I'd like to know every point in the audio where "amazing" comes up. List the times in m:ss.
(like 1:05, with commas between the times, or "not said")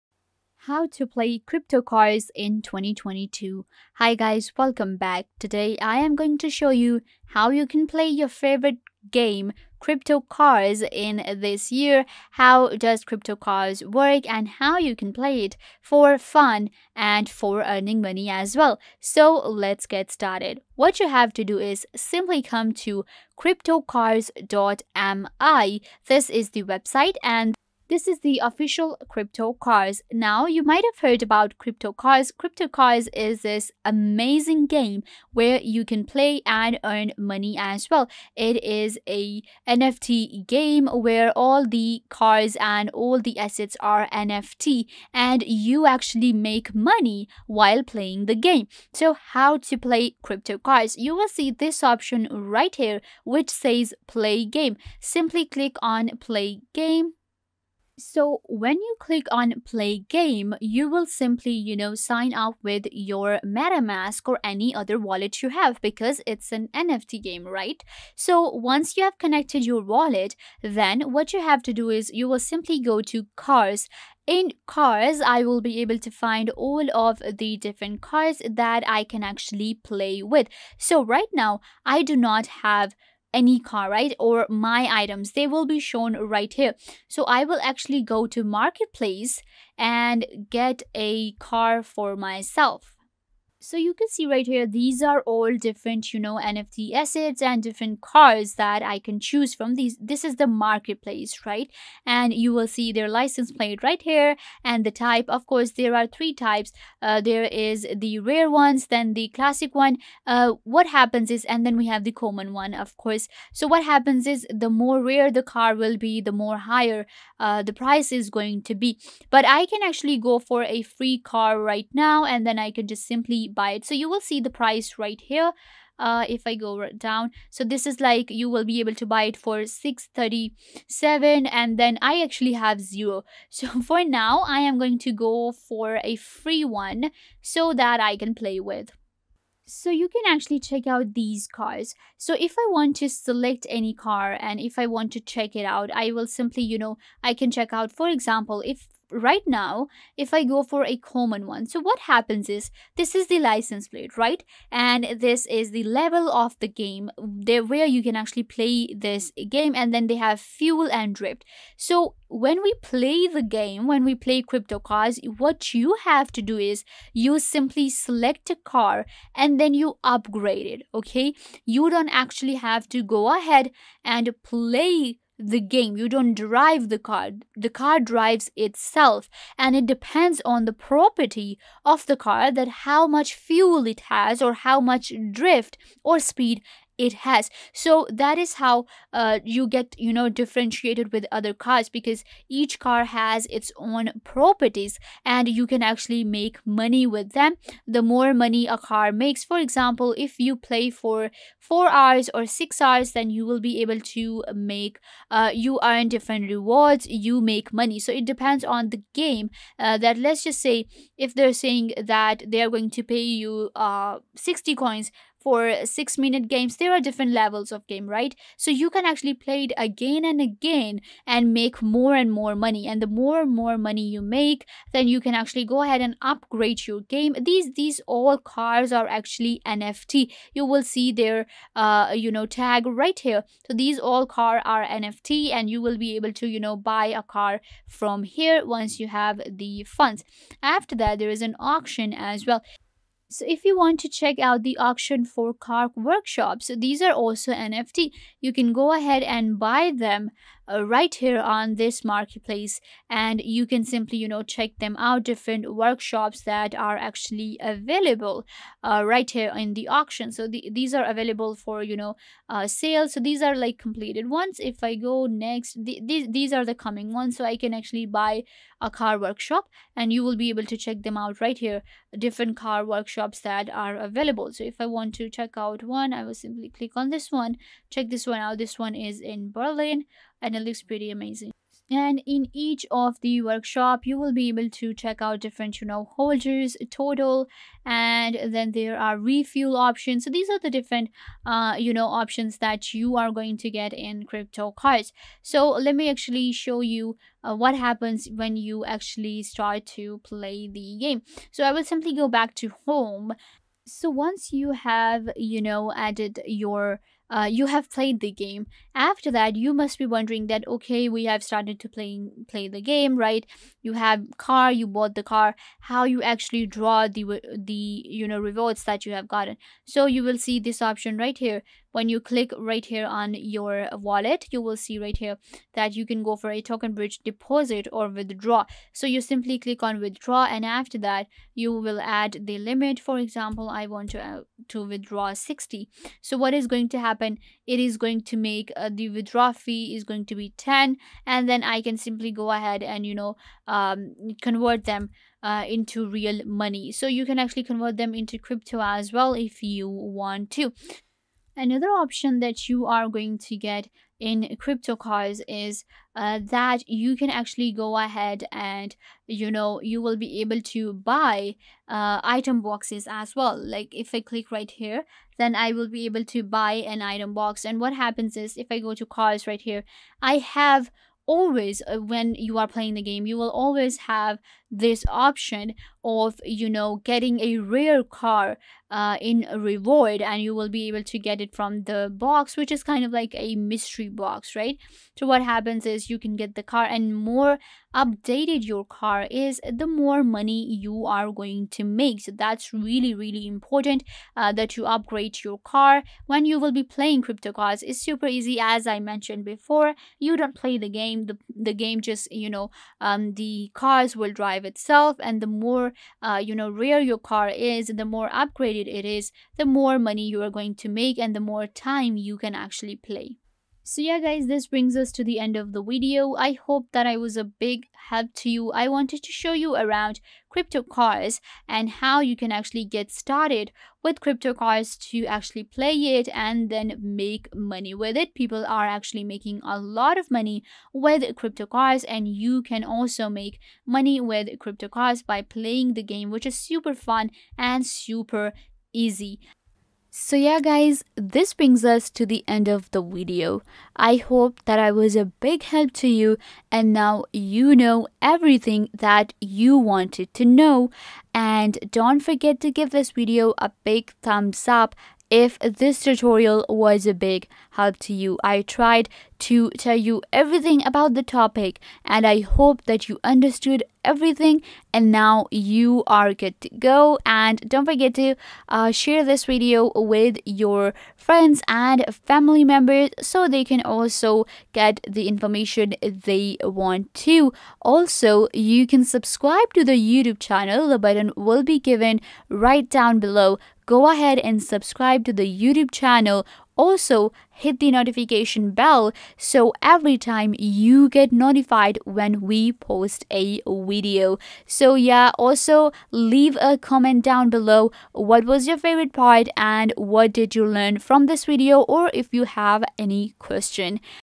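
0:33, 4:41.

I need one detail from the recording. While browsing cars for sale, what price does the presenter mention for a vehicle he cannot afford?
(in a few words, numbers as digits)
637.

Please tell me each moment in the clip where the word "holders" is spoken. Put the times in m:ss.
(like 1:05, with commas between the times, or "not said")
4:46.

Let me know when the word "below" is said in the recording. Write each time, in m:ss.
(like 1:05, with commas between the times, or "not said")
8:03, 8:17.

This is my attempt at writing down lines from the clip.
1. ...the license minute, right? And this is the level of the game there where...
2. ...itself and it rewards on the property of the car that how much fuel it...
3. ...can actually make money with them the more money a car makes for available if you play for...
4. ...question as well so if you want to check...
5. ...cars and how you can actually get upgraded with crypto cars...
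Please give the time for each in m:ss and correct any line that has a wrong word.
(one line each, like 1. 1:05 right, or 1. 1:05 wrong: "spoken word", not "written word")
1. 2:33 wrong: "plate", not "minute"
2. 2:58 wrong: "depends", not "rewards"
3. 3:15 wrong: "example", not "available"
4. 4:01 wrong: "auction", not "question"
5. 7:00 wrong: "started", not "upgraded".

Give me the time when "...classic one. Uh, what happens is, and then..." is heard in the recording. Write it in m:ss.
1:49.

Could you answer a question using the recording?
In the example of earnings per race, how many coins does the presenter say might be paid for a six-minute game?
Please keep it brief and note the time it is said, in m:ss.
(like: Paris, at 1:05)
60, at 3:34.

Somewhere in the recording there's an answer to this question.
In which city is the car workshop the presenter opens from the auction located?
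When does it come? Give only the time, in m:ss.
4:39.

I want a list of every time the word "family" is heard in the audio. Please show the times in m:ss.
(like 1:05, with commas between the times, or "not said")
7:52.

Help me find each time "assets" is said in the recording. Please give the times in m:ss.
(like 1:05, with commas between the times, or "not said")
0:43, 1:36.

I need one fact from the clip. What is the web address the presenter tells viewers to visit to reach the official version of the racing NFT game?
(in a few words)
cryptocars.me.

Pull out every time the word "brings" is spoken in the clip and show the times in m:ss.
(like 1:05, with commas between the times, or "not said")
6:54, 7:21.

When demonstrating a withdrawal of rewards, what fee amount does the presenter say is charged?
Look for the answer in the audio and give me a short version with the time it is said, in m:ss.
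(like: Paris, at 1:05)
10, at 5:40.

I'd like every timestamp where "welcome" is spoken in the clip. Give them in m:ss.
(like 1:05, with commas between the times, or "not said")
0:04.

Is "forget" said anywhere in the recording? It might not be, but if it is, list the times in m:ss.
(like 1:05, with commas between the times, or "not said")
7:32, 7:47.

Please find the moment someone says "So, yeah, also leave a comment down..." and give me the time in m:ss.
8:14.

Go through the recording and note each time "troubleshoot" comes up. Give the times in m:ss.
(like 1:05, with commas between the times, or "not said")
not said.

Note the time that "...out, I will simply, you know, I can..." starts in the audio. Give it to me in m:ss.
2:25.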